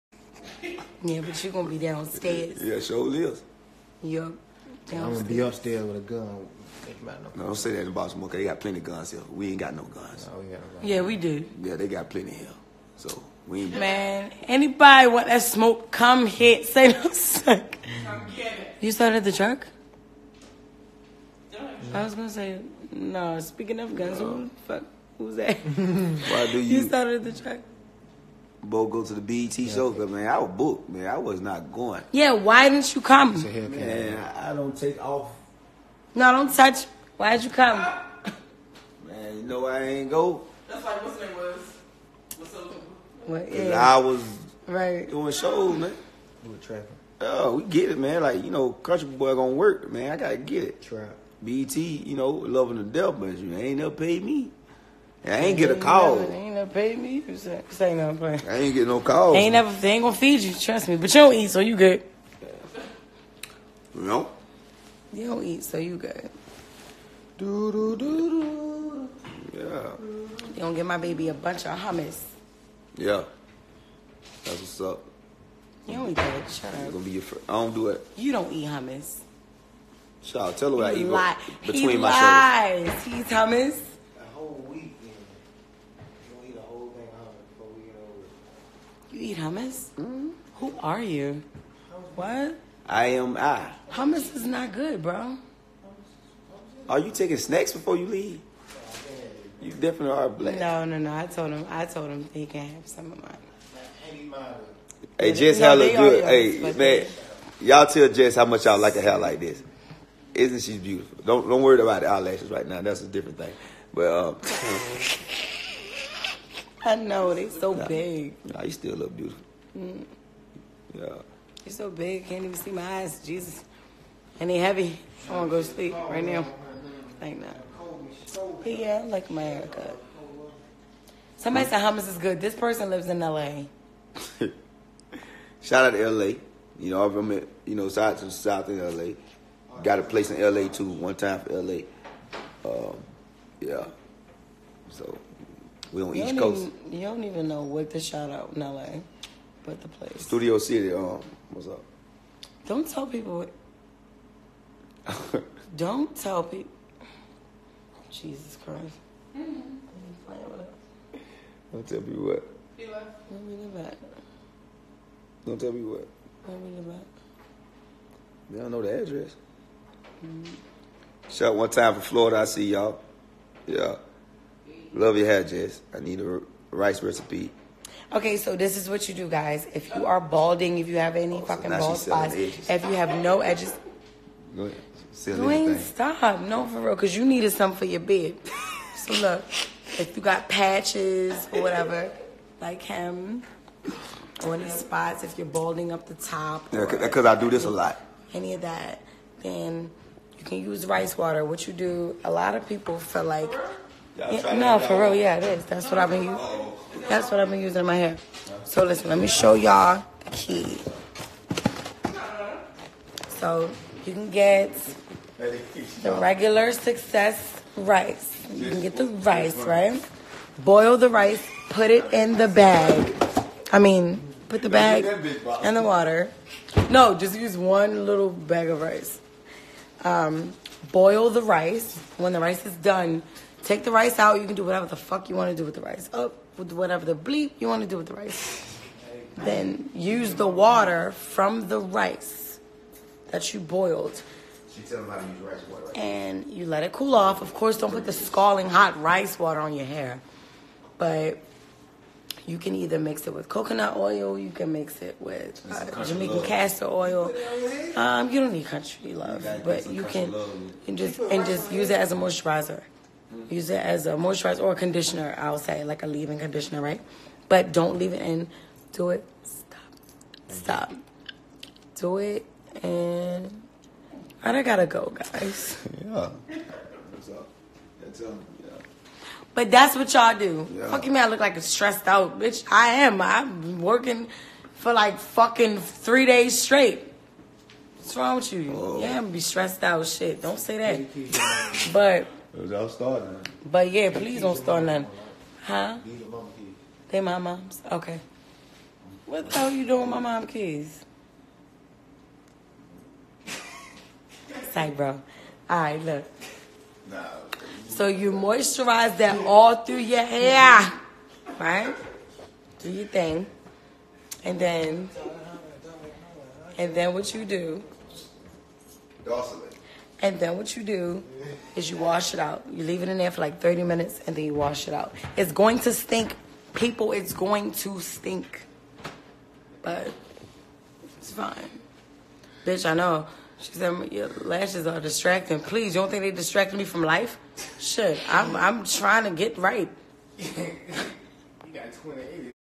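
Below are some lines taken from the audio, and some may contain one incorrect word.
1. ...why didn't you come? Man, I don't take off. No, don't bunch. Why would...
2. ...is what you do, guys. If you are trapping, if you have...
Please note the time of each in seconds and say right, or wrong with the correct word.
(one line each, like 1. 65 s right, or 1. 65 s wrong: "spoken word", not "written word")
1. 32 s wrong: "touch", not "bunch"
2. 178 s wrong: "balding", not "trapping".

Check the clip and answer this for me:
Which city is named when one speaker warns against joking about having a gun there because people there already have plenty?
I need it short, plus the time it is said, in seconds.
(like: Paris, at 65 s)
Baltimore, at 7 s.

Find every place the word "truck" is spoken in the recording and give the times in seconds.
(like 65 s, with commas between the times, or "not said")
19 s, 27 s.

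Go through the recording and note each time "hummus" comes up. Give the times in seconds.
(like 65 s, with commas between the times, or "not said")
71 s, 78 s, 83 s, 89 s, 93 s, 131 s.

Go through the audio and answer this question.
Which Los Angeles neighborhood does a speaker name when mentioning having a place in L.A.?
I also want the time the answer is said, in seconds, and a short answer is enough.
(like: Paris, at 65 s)
Studio City, at 150 s.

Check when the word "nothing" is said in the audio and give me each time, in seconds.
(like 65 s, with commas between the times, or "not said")
58 s, 294 s.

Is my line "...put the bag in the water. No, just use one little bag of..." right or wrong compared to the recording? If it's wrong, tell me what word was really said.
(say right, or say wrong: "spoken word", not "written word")
right.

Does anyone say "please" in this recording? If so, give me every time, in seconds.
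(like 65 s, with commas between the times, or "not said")
294 s, 335 s.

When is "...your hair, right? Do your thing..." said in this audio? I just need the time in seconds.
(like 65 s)
309 s.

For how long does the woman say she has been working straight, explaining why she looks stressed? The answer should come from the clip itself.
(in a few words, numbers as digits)
3 days.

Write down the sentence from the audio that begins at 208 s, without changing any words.
So listen, let me show y'all the key.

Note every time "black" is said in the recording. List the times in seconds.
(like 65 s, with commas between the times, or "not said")
100 s.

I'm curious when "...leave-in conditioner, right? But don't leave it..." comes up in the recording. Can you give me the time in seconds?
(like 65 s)
266 s.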